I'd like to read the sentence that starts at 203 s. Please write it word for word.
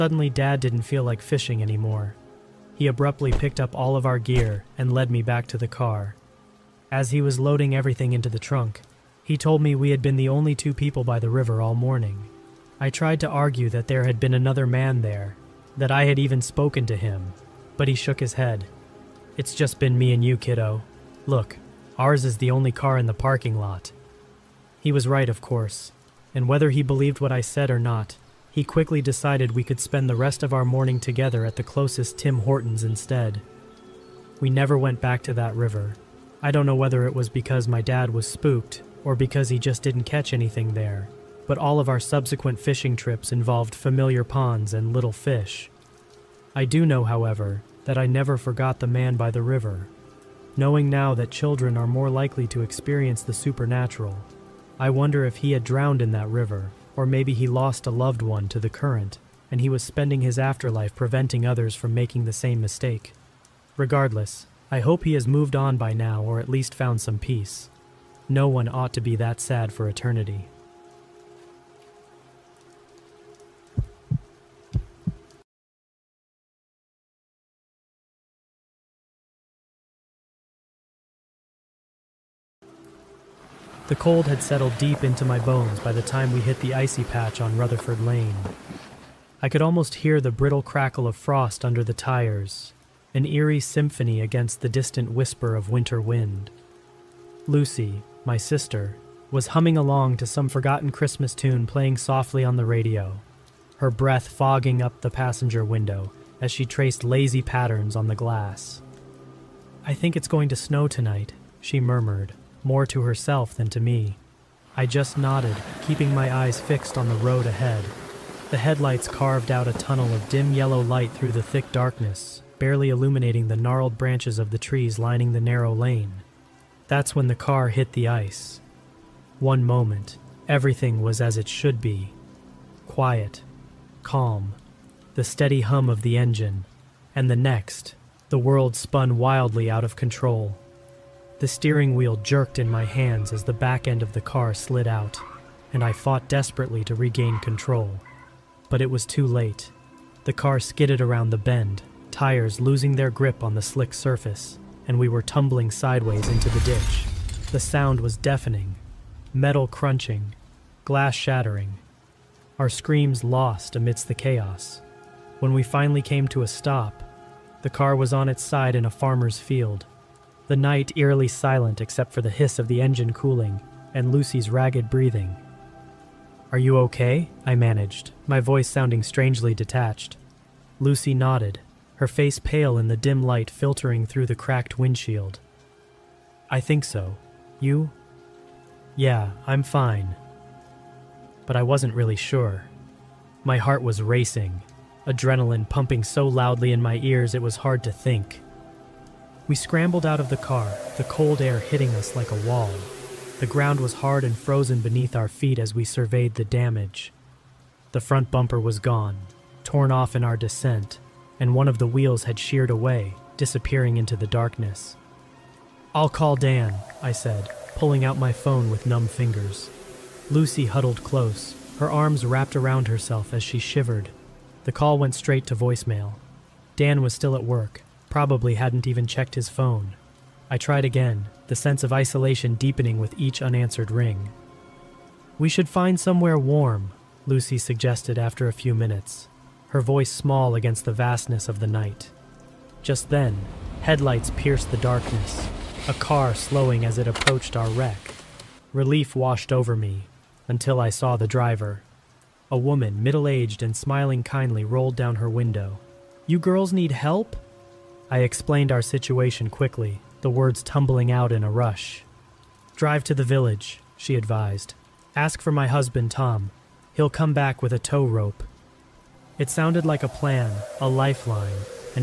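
The ground was hard and frozen beneath our feet as we surveyed the damage.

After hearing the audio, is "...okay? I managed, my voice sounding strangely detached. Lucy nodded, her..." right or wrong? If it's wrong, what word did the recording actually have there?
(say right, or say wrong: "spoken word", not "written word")
right.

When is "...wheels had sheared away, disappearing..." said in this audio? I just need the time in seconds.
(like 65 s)
211 s.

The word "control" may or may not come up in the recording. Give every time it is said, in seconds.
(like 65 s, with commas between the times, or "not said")
139 s, 147 s.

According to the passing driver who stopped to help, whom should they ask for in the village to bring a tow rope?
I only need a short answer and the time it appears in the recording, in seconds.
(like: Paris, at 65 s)
Tom, at 266 s.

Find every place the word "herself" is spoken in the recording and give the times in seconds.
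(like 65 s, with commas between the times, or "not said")
113 s, 222 s.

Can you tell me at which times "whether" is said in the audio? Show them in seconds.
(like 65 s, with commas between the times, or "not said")
26 s, 36 s.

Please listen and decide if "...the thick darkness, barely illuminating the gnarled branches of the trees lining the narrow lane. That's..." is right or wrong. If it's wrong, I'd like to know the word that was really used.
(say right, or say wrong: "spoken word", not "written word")
right.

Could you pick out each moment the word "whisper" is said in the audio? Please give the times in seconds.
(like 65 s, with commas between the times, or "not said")
95 s.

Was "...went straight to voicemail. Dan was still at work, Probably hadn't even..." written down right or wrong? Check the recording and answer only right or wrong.
right.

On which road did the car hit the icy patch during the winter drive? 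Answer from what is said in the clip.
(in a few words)
Rutherford Lane.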